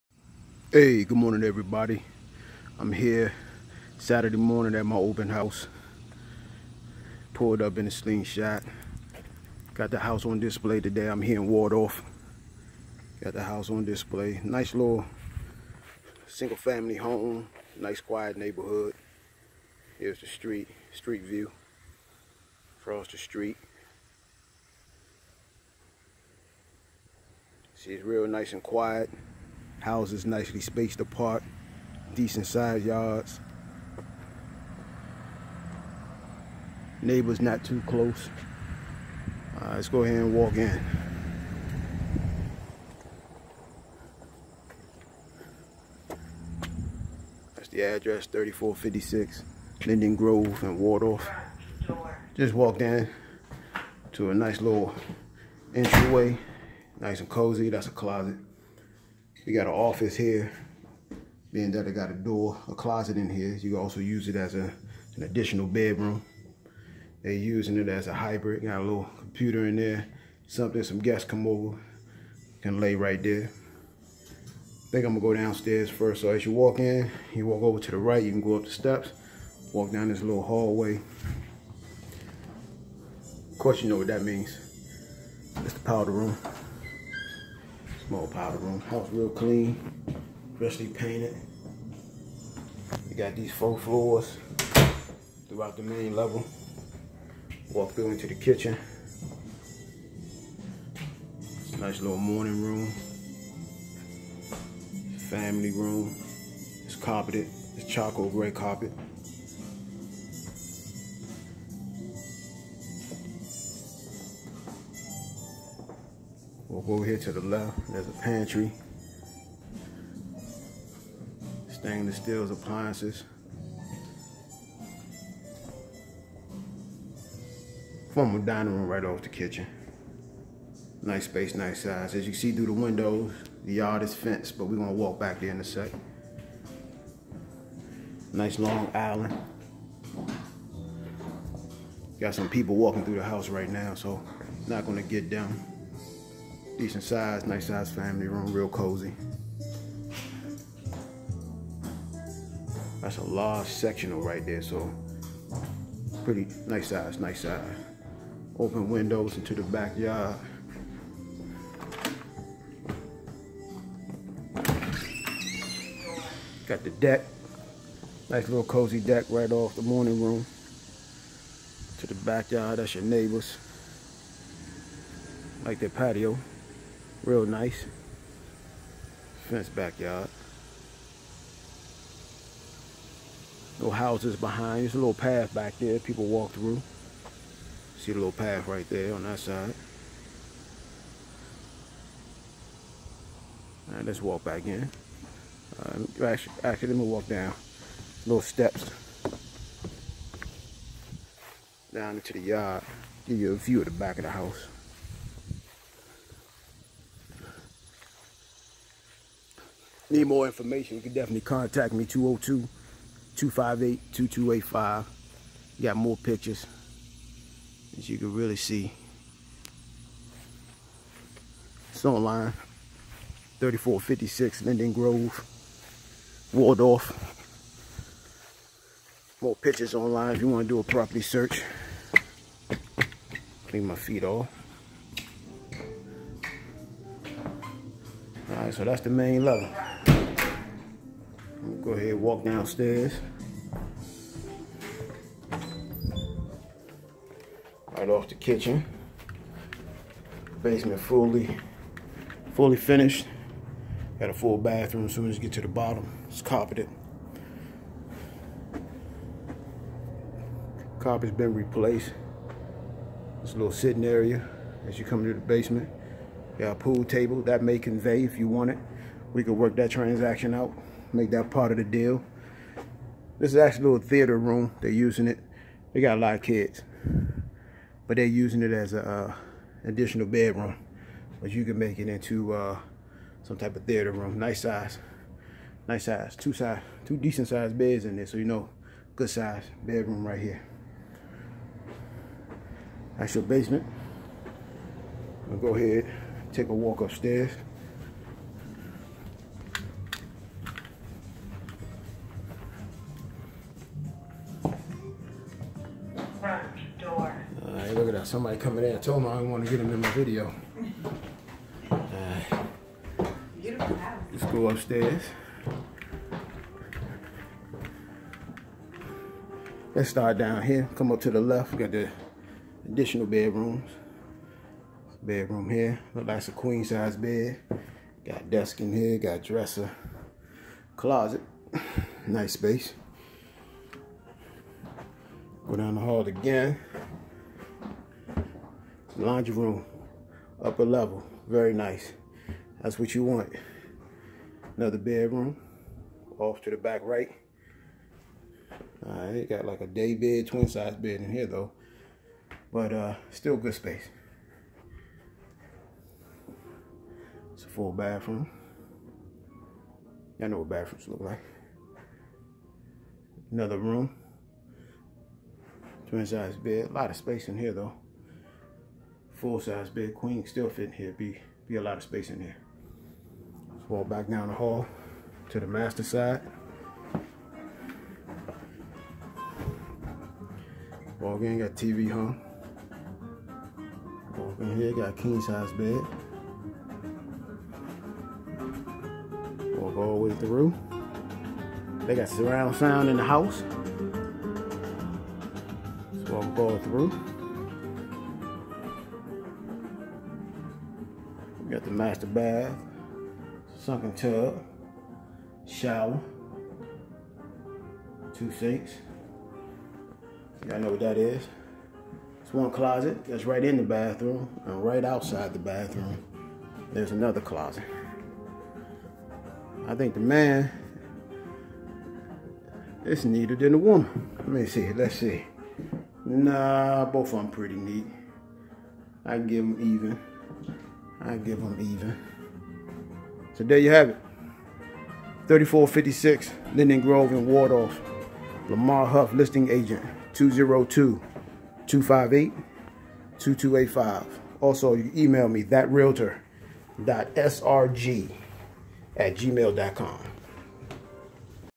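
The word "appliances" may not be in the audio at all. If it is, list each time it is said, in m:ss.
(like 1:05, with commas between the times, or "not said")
2:02.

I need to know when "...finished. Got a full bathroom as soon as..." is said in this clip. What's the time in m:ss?
4:12.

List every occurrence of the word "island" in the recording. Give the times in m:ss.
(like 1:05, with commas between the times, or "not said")
2:18.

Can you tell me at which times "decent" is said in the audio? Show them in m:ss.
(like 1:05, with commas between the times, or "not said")
0:32, 2:26, 4:47.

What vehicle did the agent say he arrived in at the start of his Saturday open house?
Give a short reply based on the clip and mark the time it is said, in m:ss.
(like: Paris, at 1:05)
Slingshot, at 0:07.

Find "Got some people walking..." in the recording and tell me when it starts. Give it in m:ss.
2:22.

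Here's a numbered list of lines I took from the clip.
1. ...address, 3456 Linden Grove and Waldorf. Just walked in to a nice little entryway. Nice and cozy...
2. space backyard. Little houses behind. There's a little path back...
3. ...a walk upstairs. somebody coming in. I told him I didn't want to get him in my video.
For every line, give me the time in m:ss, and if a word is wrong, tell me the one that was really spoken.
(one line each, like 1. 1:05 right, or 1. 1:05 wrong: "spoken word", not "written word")
1. 0:47 right
2. 2:59 wrong: "fence", not "space"
3. 4:56 right.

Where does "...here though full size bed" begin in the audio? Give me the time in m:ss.
6:07.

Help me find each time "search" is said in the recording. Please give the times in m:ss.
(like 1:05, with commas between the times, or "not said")
3:51.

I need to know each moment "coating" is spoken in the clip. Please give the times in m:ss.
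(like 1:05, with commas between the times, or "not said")
not said.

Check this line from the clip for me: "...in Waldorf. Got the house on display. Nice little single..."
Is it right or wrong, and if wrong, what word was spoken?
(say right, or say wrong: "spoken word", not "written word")
right.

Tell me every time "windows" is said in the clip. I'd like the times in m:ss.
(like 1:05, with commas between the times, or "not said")
2:12, 2:38.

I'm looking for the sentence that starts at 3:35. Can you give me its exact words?
Got more pictures, as you can really see.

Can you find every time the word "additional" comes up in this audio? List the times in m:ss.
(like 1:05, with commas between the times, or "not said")
1:05, 4:39, 5:22.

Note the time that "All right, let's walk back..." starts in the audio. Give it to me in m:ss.
3:13.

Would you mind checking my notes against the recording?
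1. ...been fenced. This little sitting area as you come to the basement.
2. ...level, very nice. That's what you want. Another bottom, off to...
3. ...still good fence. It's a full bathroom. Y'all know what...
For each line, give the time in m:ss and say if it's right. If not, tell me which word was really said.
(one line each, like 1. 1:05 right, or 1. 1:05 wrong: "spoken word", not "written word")
1. 4:21 wrong: "replaced", not "fenced"
2. 5:40 wrong: "bedroom", not "bottom"
3. 5:53 wrong: "space", not "fence".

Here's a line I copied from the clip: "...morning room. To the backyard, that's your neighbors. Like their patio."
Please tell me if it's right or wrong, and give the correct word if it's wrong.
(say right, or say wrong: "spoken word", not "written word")
right.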